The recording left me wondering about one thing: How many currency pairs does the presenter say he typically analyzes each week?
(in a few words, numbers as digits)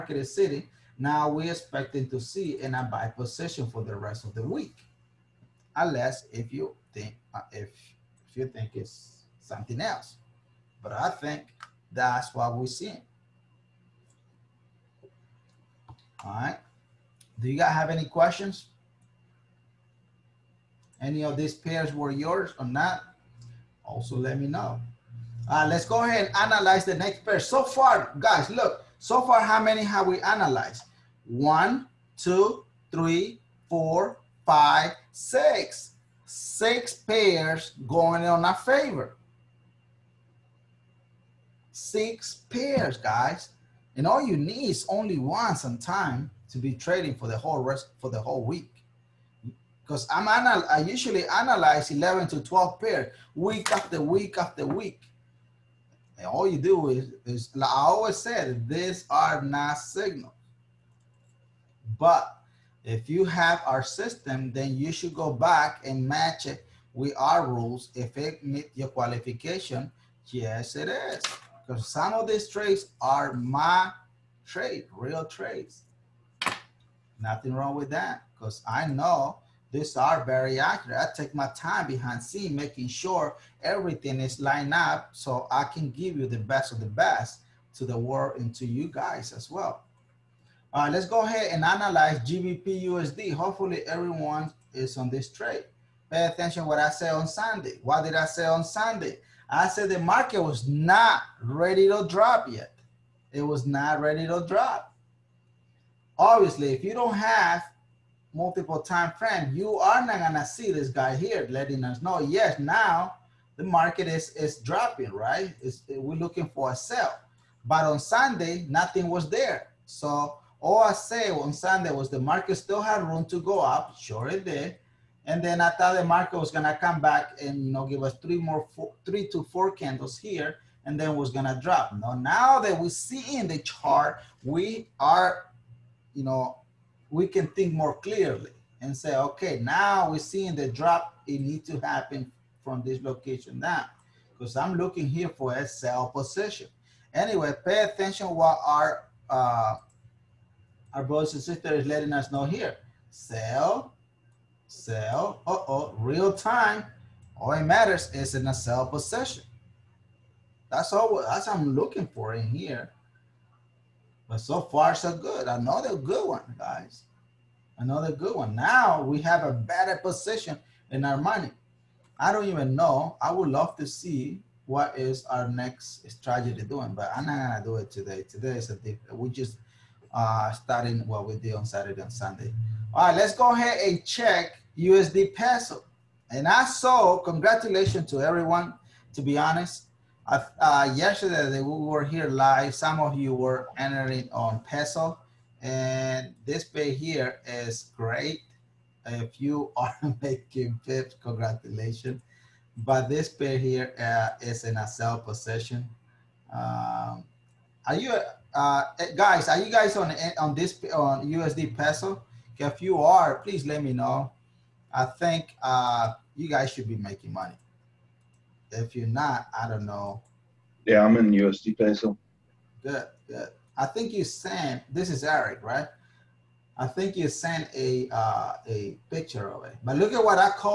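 11 to 12.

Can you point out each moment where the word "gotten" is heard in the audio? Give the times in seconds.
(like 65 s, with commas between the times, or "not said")
not said.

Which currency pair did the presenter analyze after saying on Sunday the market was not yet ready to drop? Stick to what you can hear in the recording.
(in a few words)
GBP USD.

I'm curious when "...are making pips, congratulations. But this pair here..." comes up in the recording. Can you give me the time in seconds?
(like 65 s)
199 s.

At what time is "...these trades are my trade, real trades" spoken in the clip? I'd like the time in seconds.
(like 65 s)
72 s.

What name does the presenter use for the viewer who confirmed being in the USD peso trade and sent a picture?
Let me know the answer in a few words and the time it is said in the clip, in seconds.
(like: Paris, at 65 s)
Eric, at 225 s.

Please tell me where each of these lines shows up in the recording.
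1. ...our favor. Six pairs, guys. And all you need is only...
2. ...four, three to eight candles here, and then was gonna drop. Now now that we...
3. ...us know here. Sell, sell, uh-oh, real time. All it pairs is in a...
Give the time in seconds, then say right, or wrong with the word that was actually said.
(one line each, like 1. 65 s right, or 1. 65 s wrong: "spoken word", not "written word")
1. 38 s right
2. 128 s wrong: "four", not "eight"
3. 152 s wrong: "matters", not "pairs".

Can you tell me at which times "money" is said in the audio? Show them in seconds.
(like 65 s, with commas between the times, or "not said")
171 s, 217 s.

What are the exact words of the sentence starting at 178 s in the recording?
Today is a we just uh, starting what we did on Saturday and Sunday.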